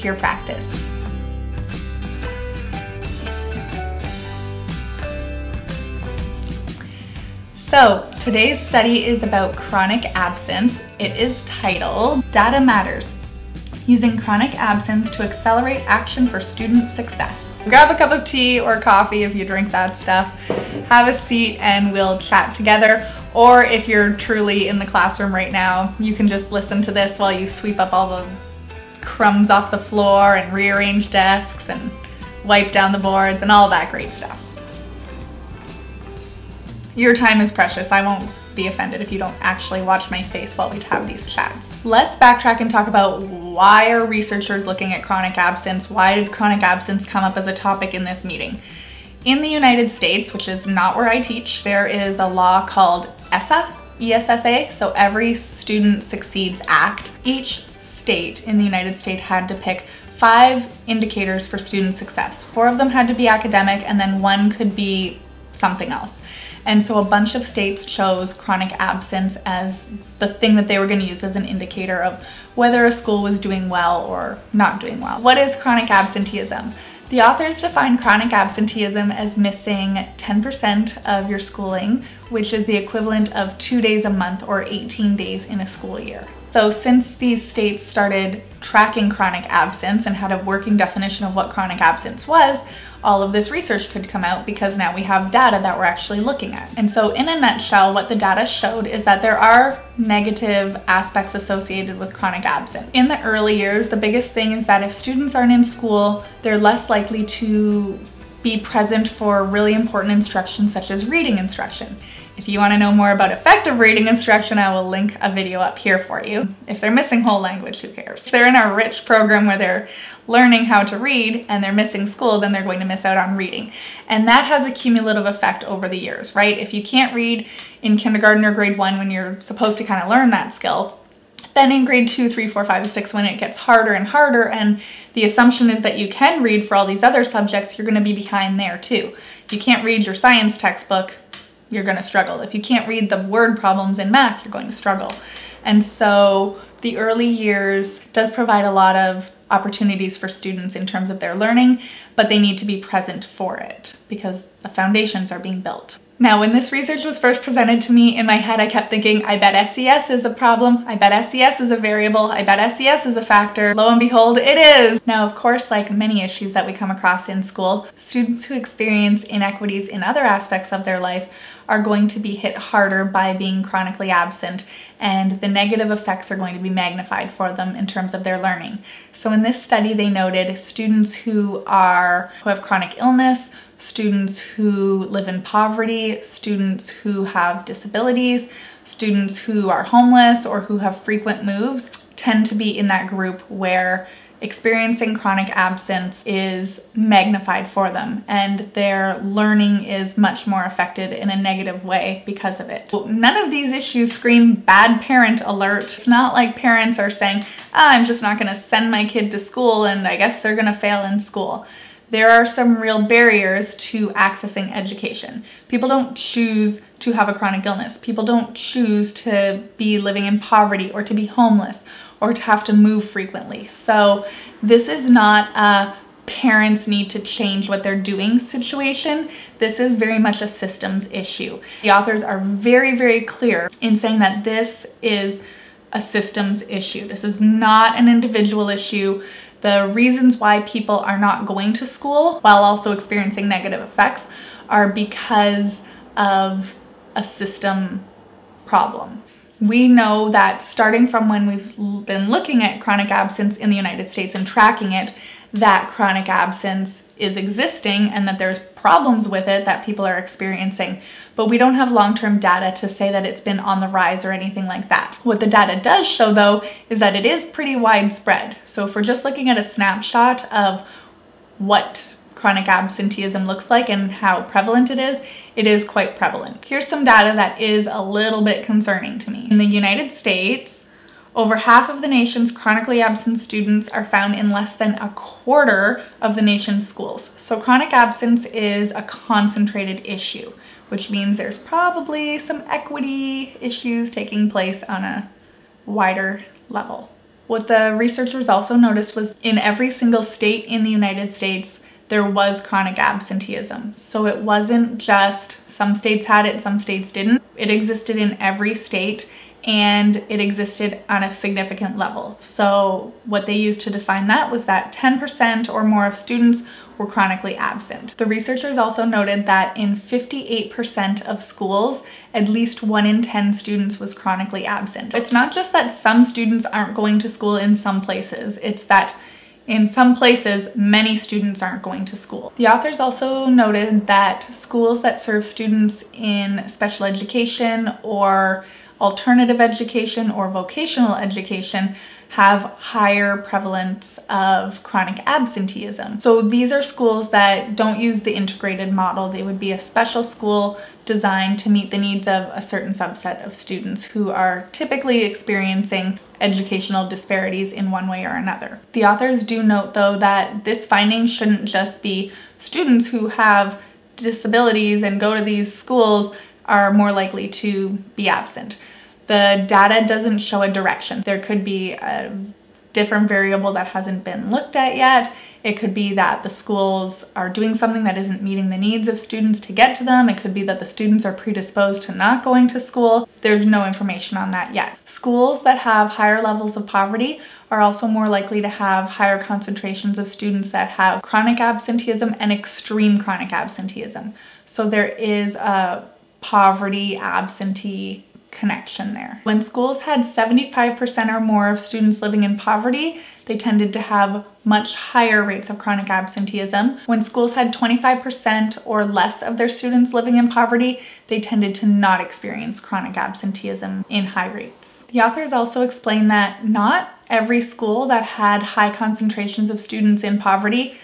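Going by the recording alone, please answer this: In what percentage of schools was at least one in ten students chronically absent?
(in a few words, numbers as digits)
58%.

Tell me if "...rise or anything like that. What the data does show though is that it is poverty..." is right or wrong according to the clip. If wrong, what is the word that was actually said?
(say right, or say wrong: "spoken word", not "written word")
wrong: "pretty", not "poverty".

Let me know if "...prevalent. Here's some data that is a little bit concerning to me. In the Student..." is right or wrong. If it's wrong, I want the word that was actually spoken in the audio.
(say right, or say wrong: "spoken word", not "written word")
wrong: "United", not "Student".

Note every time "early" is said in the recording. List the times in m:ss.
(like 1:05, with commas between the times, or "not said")
1:43, 2:26.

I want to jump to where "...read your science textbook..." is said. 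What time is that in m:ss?
2:19.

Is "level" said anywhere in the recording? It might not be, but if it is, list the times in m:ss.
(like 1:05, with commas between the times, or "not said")
4:56, 5:11, 6:26.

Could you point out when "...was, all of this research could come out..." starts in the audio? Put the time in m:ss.
1:32.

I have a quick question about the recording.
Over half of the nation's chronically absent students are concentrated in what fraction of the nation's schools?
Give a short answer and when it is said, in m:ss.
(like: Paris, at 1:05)
less than a quarter, at 4:44.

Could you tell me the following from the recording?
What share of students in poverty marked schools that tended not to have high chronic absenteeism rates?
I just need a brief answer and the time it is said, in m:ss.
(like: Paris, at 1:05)
25% or less, at 6:47.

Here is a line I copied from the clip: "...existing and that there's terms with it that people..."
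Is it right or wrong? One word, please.
wrong.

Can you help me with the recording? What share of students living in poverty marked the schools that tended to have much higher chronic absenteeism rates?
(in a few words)
75% or more.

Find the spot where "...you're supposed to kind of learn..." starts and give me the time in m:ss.
2:09.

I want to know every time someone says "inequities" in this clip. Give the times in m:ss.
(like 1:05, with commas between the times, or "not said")
2:49.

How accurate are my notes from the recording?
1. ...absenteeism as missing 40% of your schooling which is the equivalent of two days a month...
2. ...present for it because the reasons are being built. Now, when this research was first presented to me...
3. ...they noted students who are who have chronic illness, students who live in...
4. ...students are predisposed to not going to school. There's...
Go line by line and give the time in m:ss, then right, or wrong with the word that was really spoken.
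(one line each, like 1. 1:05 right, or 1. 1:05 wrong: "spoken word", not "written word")
1. 1:18 wrong: "10", not "40"
2. 2:32 wrong: "foundations", not "reasons"
3. 2:59 right
4. 6:20 right.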